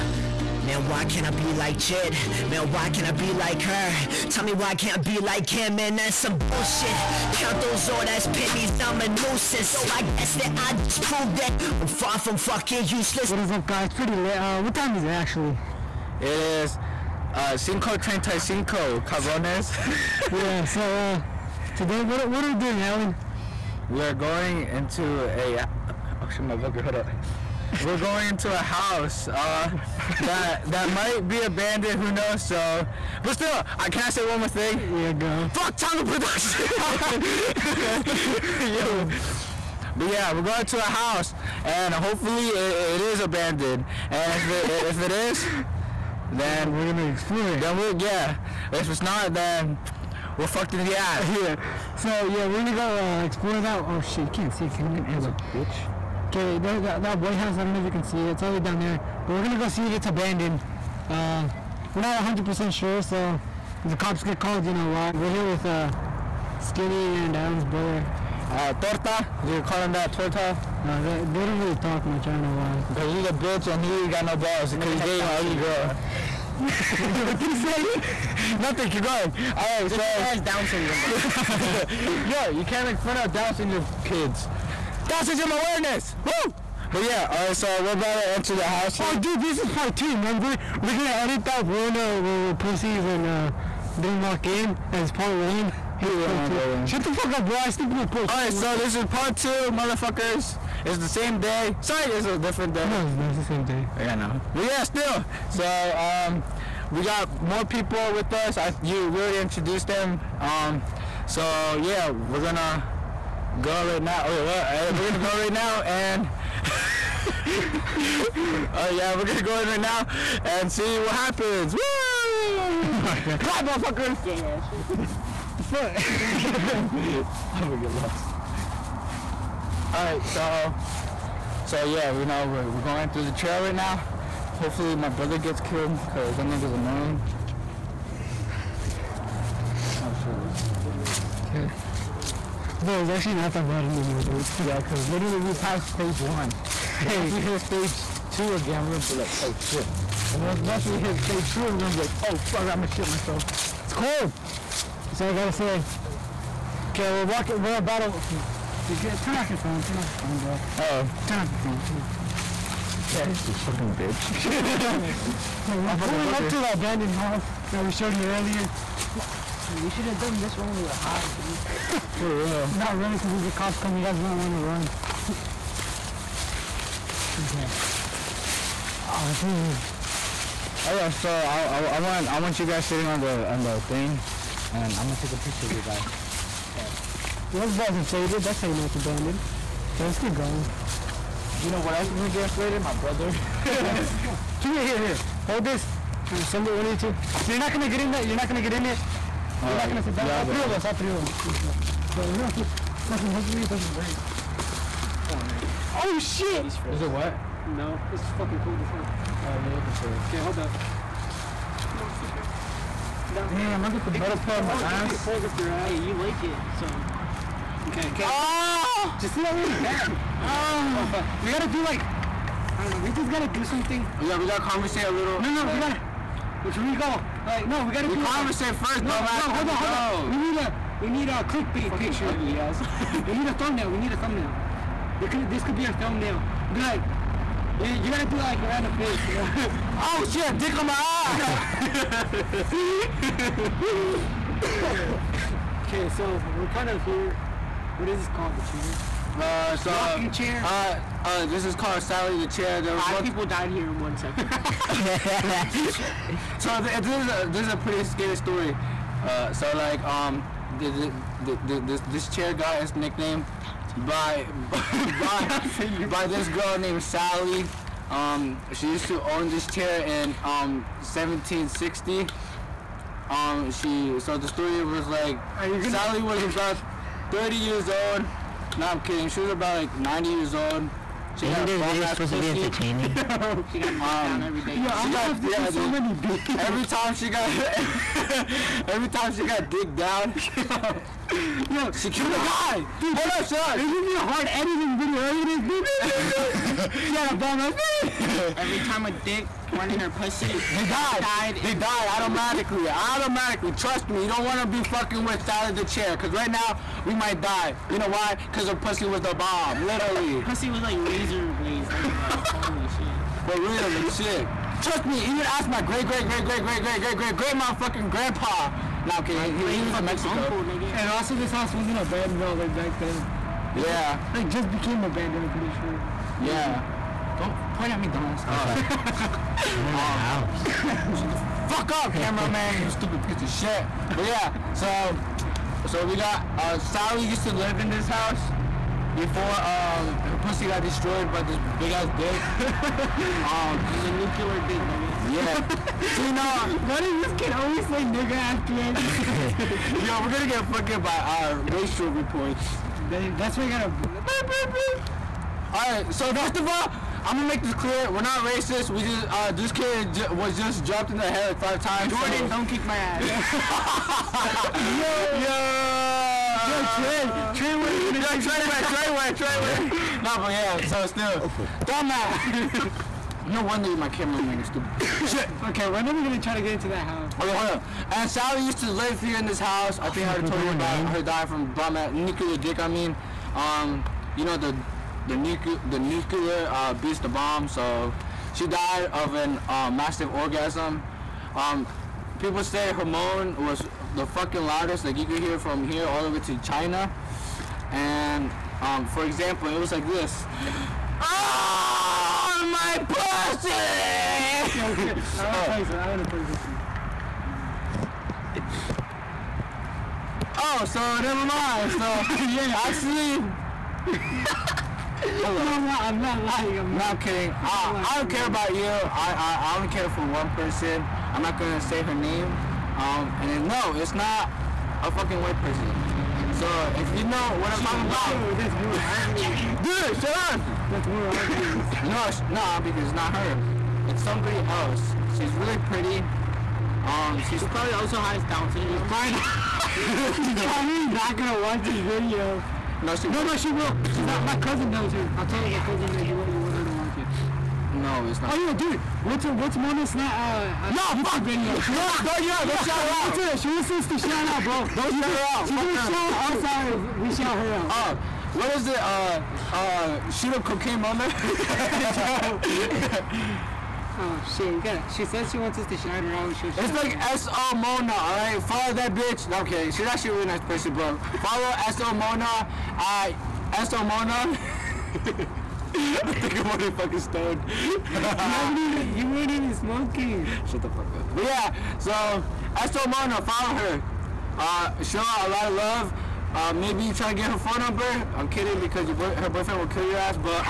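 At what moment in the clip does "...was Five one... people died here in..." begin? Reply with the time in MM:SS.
04:12.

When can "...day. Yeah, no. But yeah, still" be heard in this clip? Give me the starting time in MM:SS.
01:43.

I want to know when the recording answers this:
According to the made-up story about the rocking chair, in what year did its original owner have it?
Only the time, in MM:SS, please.
04:31.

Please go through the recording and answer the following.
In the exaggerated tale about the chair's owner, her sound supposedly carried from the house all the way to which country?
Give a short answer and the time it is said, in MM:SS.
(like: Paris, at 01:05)
China, at 06:36.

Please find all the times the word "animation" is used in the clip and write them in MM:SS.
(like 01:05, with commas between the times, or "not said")
not said.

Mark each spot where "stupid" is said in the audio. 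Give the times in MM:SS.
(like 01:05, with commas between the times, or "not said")
05:32, 06:14.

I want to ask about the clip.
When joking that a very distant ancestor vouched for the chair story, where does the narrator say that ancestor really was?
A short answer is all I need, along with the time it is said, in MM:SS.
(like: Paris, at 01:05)
Mexico, at 05:20.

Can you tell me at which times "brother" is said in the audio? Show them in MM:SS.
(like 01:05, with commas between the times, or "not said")
01:07, 02:15, 03:12.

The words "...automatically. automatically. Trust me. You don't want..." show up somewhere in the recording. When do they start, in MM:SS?
05:02.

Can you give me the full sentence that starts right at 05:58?
We just uh, this kid was just dropped in the head like five times.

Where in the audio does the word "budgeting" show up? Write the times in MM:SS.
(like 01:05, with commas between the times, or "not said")
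not said.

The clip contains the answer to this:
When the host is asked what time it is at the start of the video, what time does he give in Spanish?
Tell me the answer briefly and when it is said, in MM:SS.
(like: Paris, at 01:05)
5:35, at 00:17.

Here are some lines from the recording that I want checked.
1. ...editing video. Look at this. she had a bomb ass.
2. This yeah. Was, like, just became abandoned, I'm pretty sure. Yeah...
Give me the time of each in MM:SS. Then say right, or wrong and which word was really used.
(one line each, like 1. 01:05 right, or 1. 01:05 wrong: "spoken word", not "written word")
1. 04:54 right
2. 05:23 right.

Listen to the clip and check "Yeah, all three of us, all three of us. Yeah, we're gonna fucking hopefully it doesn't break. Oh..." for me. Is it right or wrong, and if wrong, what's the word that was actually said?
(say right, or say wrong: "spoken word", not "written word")
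right.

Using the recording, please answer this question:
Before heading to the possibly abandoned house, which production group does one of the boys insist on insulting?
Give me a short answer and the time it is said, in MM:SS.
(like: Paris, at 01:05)
Tonga Production, at 00:35.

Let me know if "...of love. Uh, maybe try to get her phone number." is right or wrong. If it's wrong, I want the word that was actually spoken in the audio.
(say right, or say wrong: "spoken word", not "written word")
right.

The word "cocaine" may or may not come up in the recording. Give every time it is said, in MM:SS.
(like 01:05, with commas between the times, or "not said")
07:40.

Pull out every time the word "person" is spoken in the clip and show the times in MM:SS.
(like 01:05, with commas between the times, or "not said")
07:00, 07:05, 07:50.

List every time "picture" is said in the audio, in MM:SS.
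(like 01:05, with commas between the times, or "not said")
03:05, 03:52.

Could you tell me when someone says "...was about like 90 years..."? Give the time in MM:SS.
04:39.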